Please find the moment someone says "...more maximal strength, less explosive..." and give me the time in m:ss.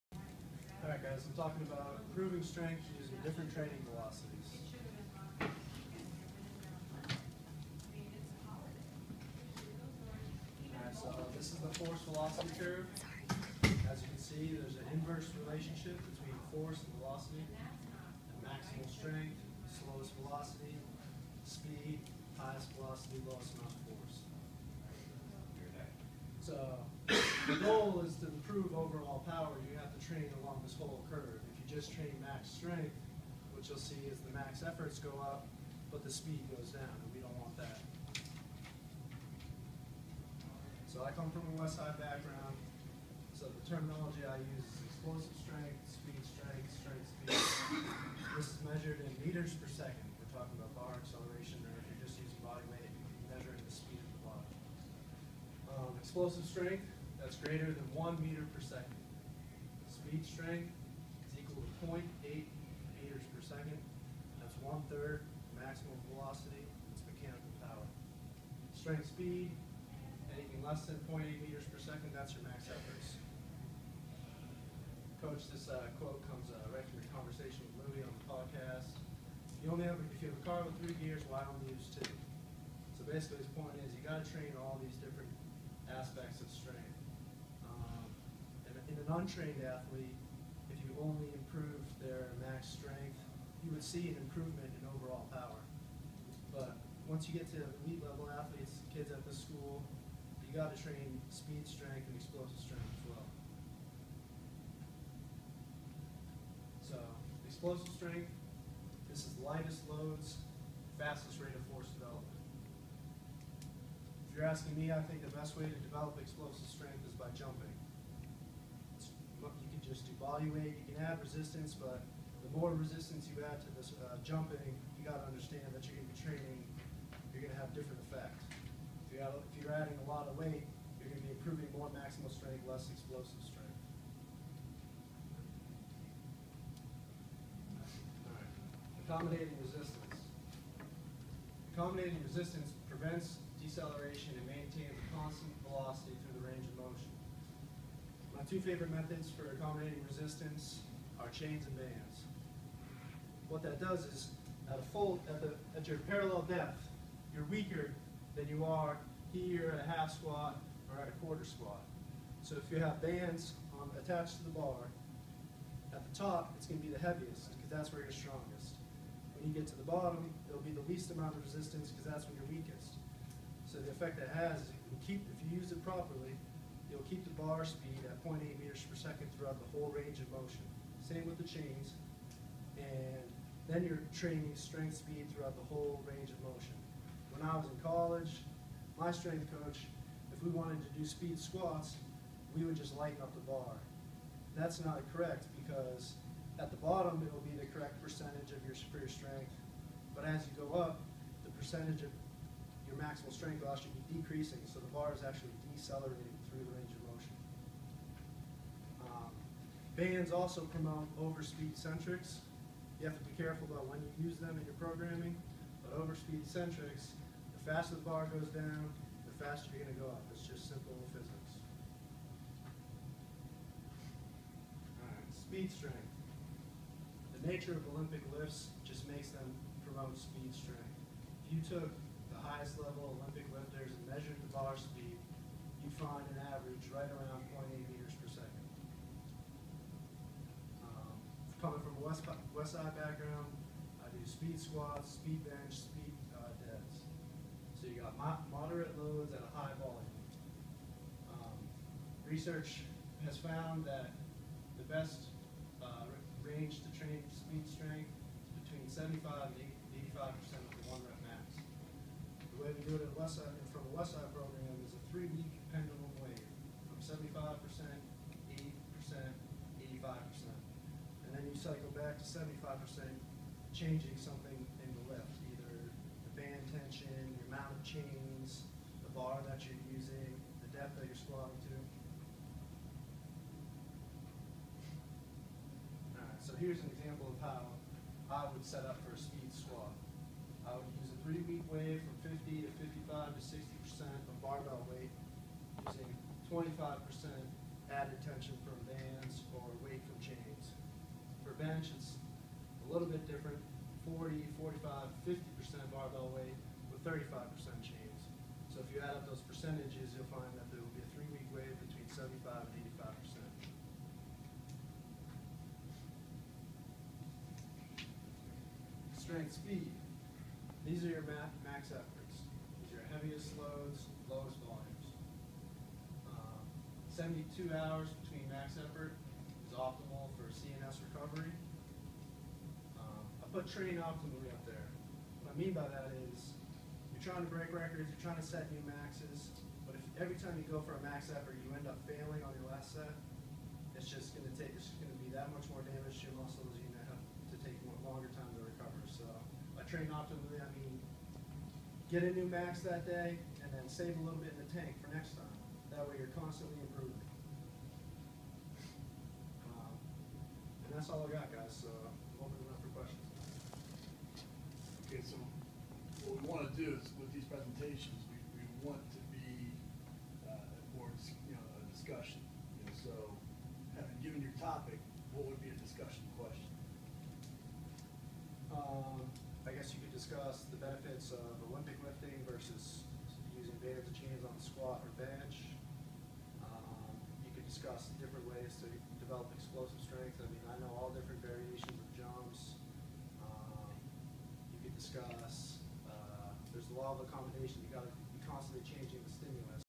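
2:11.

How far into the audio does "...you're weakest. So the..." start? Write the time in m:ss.
2:52.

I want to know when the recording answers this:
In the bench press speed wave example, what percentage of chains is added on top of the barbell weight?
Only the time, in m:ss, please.
5:07.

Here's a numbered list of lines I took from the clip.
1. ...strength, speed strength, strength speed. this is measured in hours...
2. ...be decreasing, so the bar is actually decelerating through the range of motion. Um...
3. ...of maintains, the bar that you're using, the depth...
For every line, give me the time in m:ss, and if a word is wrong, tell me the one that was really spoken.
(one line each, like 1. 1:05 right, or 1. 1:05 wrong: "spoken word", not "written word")
1. 0:45 wrong: "meters", not "hours"
2. 3:23 right
3. 4:37 wrong: "chains", not "maintains".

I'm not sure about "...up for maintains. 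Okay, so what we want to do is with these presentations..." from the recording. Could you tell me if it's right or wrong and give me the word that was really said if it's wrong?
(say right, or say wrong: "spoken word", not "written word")
wrong: "questions", not "maintains".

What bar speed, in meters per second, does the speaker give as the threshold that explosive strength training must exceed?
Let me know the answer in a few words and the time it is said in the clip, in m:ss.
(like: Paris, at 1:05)
1 meter per second, at 0:57.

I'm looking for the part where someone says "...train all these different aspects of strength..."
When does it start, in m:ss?
1:24.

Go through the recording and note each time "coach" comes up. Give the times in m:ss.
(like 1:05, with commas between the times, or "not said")
1:15, 3:09.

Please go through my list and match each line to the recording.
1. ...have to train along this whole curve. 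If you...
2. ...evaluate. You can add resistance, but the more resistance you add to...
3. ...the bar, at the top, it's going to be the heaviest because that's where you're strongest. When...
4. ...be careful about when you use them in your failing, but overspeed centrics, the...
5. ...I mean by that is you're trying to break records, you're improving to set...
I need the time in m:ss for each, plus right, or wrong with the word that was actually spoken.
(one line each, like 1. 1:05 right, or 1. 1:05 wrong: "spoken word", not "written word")
1. 0:29 right
2. 2:00 right
3. 2:44 right
4. 3:33 wrong: "programming", not "failing"
5. 5:35 wrong: "trying", not "improving".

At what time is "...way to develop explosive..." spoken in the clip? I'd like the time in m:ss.
1:55.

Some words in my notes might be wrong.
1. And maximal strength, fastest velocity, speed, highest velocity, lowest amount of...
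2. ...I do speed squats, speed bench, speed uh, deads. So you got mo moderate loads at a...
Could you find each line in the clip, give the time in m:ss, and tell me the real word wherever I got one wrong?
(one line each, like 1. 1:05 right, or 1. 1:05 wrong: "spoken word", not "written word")
1. 0:17 wrong: "slowest", not "fastest"
2. 4:04 right.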